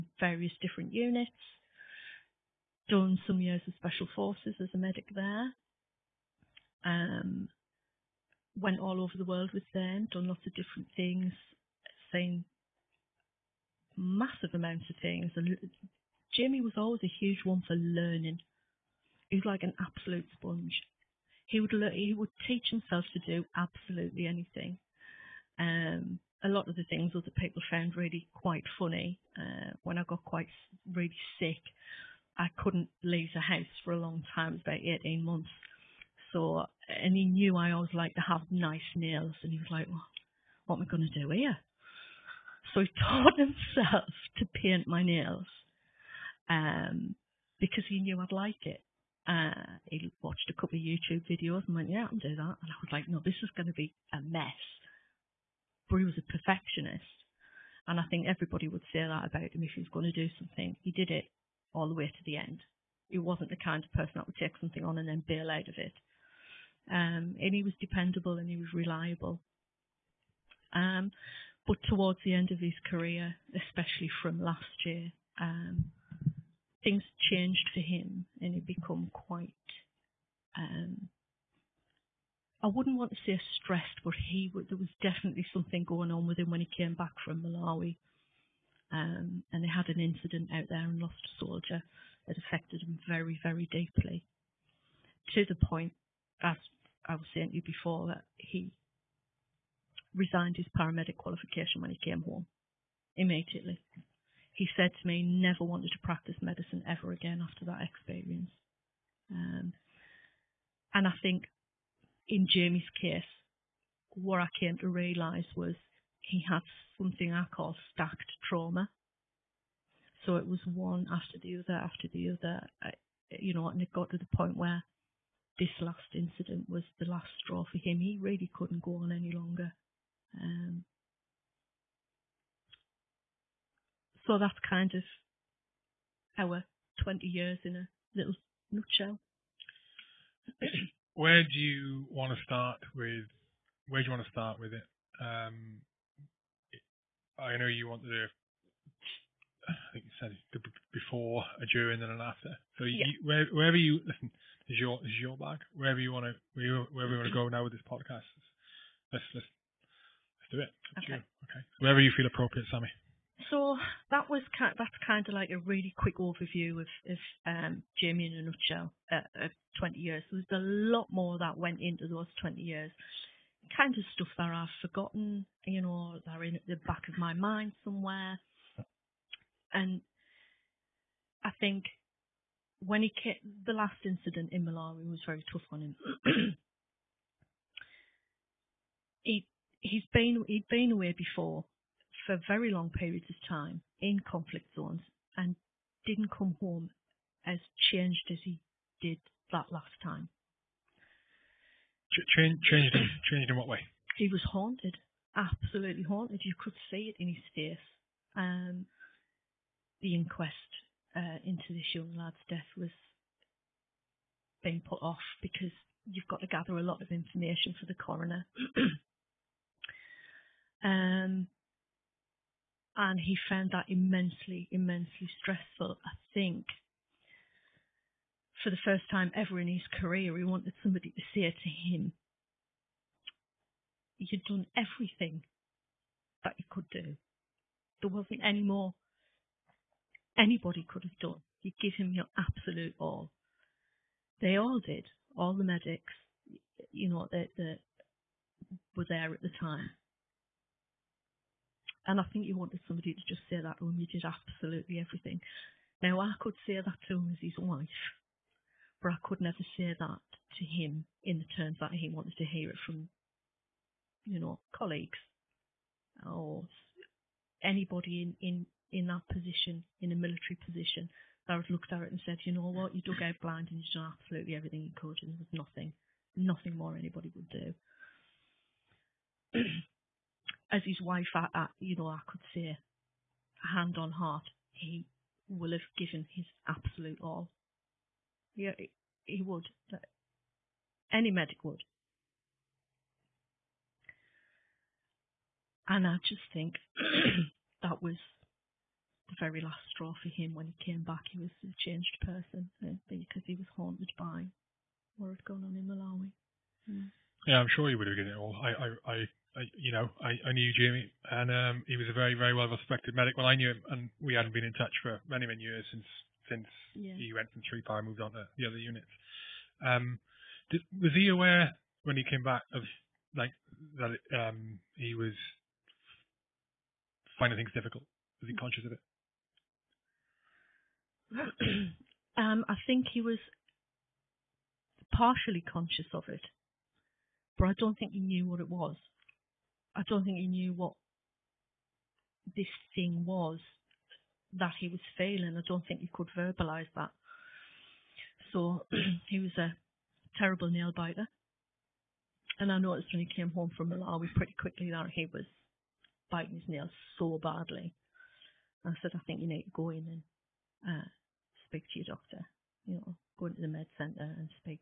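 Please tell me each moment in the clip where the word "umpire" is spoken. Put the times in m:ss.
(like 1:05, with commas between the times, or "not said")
not said.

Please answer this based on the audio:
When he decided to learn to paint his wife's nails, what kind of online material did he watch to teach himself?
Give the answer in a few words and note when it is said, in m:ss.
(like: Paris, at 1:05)
YouTube videos, at 0:50.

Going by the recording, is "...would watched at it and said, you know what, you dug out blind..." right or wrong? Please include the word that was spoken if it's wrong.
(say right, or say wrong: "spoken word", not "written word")
wrong: "looked", not "watched".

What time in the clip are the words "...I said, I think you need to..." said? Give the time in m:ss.
5:58.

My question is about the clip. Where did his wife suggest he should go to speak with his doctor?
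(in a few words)
The med centre.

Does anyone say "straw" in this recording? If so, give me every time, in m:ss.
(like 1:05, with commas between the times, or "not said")
2:07, 4:59.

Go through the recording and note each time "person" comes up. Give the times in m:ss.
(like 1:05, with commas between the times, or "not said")
1:03, 5:02.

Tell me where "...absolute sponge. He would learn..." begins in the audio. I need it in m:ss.
0:19.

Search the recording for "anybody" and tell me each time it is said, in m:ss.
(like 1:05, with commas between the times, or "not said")
4:00, 4:27, 4:36.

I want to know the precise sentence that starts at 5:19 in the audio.
Um, did, was he aware when he came back of like that it, um, he was finding things difficult?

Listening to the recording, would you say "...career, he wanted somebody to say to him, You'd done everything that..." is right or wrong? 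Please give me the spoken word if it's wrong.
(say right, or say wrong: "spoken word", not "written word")
right.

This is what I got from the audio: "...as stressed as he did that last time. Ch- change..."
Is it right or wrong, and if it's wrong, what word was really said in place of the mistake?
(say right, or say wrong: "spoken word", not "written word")
wrong: "changed", not "stressed".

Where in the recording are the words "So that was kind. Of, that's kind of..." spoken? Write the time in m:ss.
2:43.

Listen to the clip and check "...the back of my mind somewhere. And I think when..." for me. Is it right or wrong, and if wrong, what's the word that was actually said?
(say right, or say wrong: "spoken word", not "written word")
right.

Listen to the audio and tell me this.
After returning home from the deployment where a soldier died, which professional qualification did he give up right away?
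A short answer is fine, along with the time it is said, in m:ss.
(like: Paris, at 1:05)
Paramedic qualification, at 1:40.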